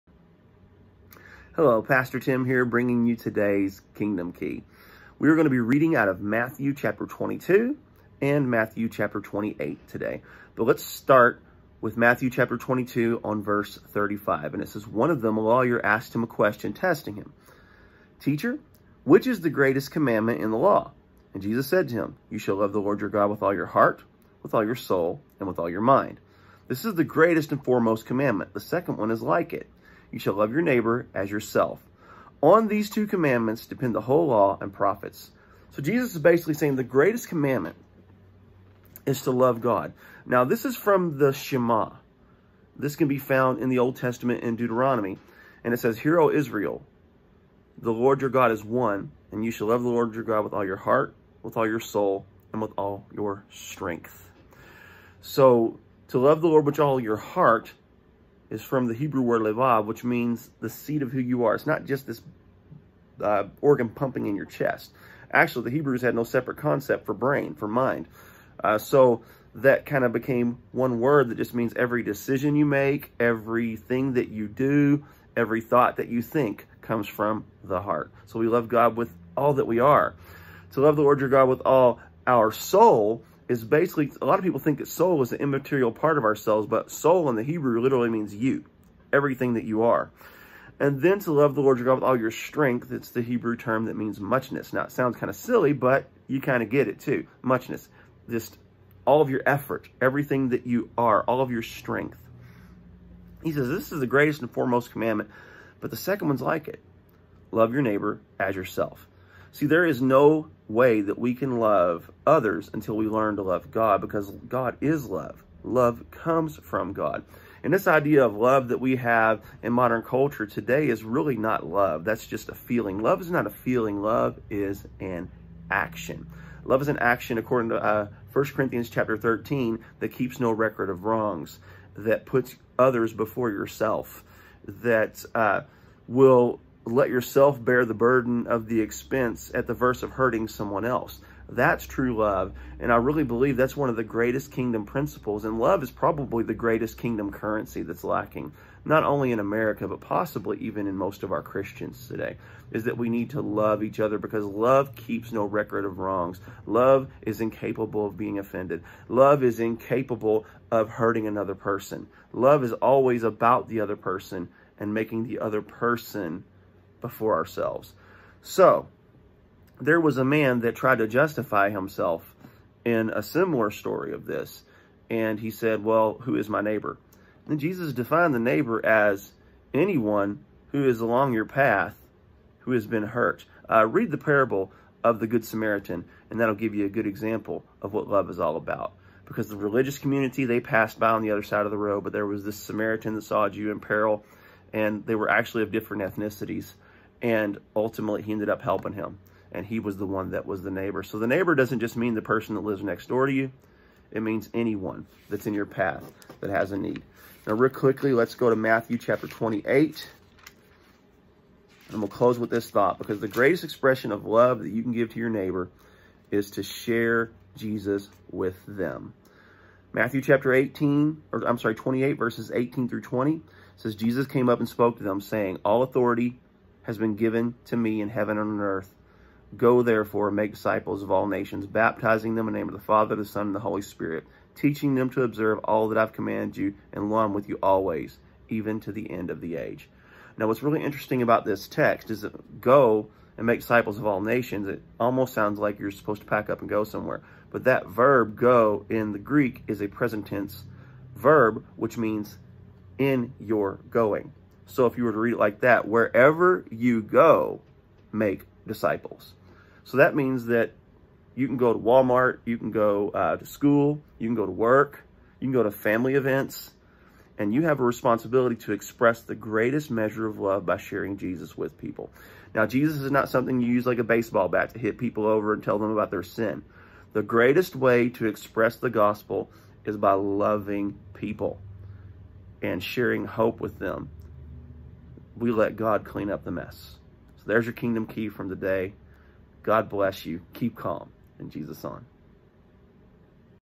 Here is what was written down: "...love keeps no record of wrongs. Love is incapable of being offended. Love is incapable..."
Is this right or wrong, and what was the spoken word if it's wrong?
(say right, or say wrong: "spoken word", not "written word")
right.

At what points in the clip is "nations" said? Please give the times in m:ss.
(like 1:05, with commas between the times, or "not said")
3:51, 4:04.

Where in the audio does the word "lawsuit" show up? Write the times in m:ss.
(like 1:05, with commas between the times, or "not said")
not said.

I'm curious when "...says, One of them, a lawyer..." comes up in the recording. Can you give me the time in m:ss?
0:14.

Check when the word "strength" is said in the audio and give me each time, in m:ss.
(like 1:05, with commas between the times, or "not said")
0:53, 1:32, 1:41.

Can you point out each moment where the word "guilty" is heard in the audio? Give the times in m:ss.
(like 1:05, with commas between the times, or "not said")
not said.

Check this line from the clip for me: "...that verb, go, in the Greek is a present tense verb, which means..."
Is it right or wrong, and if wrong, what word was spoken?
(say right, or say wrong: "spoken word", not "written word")
right.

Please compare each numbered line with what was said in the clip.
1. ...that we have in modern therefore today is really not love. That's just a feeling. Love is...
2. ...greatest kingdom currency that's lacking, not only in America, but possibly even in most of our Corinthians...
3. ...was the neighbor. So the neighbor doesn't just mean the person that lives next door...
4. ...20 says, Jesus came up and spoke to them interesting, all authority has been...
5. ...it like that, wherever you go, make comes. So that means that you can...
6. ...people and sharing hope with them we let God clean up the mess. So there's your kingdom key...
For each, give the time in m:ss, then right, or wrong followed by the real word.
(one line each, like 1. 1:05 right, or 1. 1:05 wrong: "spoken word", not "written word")
1. 1:58 wrong: "culture", not "therefore"
2. 2:26 wrong: "Christians", not "Corinthians"
3. 3:20 right
4. 3:43 wrong: "saying", not "interesting"
5. 4:15 wrong: "disciples", not "comes"
6. 4:41 right.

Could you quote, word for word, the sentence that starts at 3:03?
Uh, read the parable of the Good Samaritan, and that'll give you a good example of what love is all about.